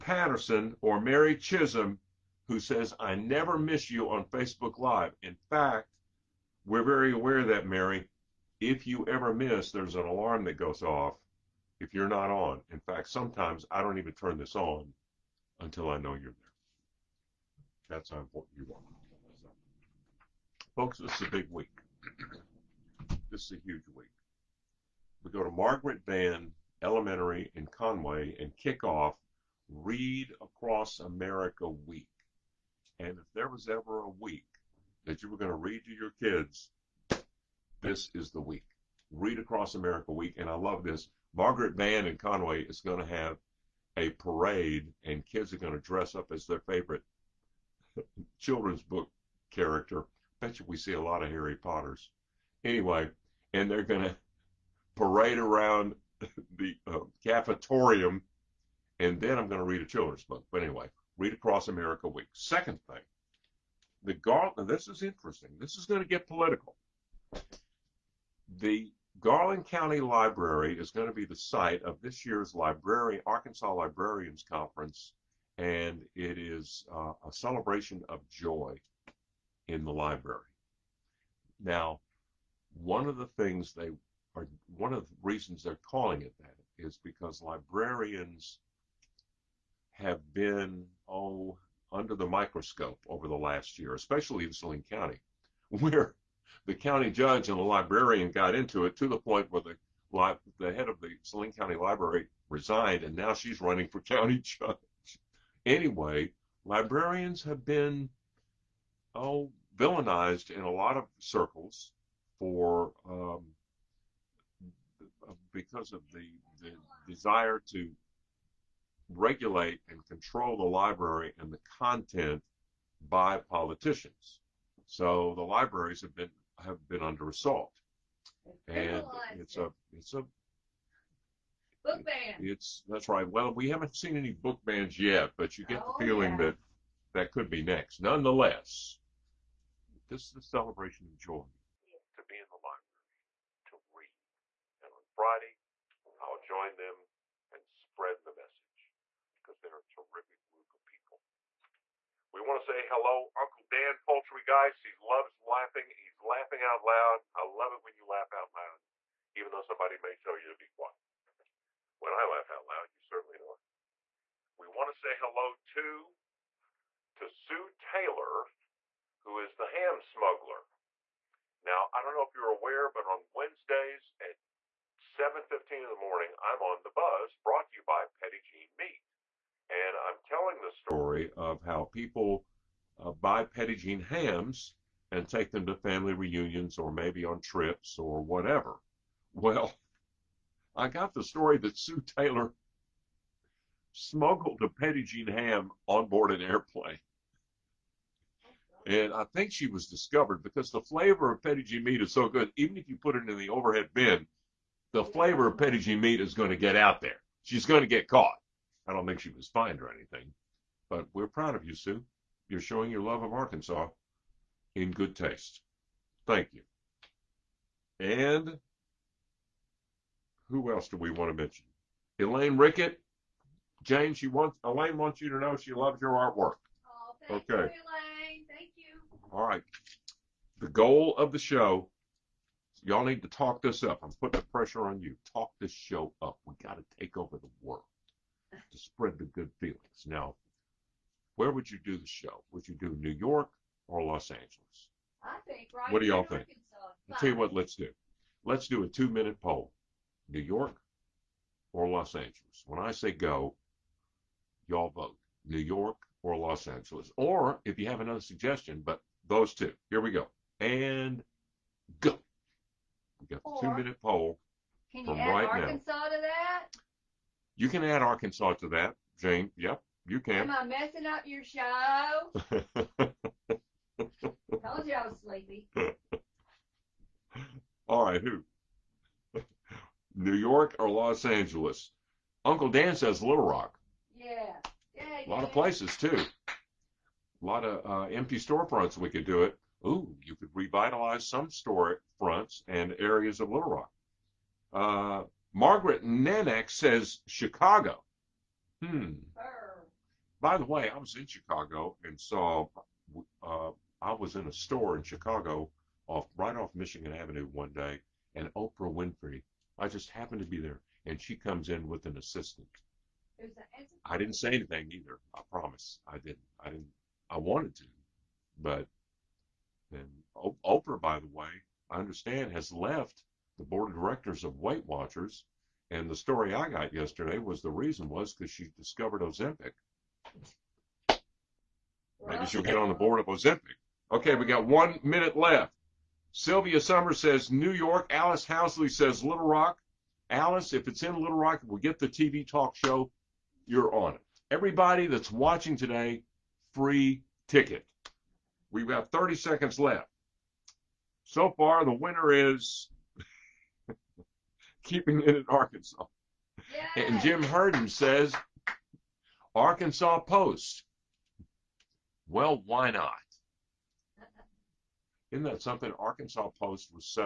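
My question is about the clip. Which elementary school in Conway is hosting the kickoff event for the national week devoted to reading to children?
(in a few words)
Margaret Van Elementary.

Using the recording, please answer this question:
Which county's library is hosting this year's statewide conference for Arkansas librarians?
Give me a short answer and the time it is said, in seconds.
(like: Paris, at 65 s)
Garland County, at 69 s.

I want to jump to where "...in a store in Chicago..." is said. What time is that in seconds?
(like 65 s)
304 s.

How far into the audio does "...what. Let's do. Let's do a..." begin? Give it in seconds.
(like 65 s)
247 s.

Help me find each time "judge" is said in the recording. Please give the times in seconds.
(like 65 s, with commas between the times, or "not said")
97 s, 104 s.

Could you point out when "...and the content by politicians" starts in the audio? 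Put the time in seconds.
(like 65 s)
121 s.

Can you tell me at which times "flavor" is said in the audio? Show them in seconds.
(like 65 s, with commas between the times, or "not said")
200 s, 205 s.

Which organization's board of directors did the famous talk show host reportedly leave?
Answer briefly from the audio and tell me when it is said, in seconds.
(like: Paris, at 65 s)
Weight Watchers, at 324 s.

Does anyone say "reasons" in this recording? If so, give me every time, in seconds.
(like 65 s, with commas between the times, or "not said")
85 s, 327 s.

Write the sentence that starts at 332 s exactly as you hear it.
Maybe she'll get on the board of Ozempic.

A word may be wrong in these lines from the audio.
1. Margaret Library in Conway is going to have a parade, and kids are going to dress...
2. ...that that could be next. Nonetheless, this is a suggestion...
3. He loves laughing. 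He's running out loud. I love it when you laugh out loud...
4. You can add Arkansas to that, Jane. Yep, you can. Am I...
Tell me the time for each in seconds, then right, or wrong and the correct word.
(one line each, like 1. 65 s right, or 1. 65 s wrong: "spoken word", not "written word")
1. 41 s wrong: "Van", not "Library"
2. 136 s wrong: "celebration", not "suggestion"
3. 154 s wrong: "laughing", not "running"
4. 267 s right.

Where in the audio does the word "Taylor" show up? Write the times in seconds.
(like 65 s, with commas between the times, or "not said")
167 s, 192 s.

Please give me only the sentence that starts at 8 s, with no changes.
If you ever miss, there's an alarm that goes off if you're not on.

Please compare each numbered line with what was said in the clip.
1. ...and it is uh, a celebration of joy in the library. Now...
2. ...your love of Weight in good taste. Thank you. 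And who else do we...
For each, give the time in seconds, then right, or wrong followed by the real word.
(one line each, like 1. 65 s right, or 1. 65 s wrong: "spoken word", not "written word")
1. 75 s right
2. 212 s wrong: "Arkansas", not "Weight".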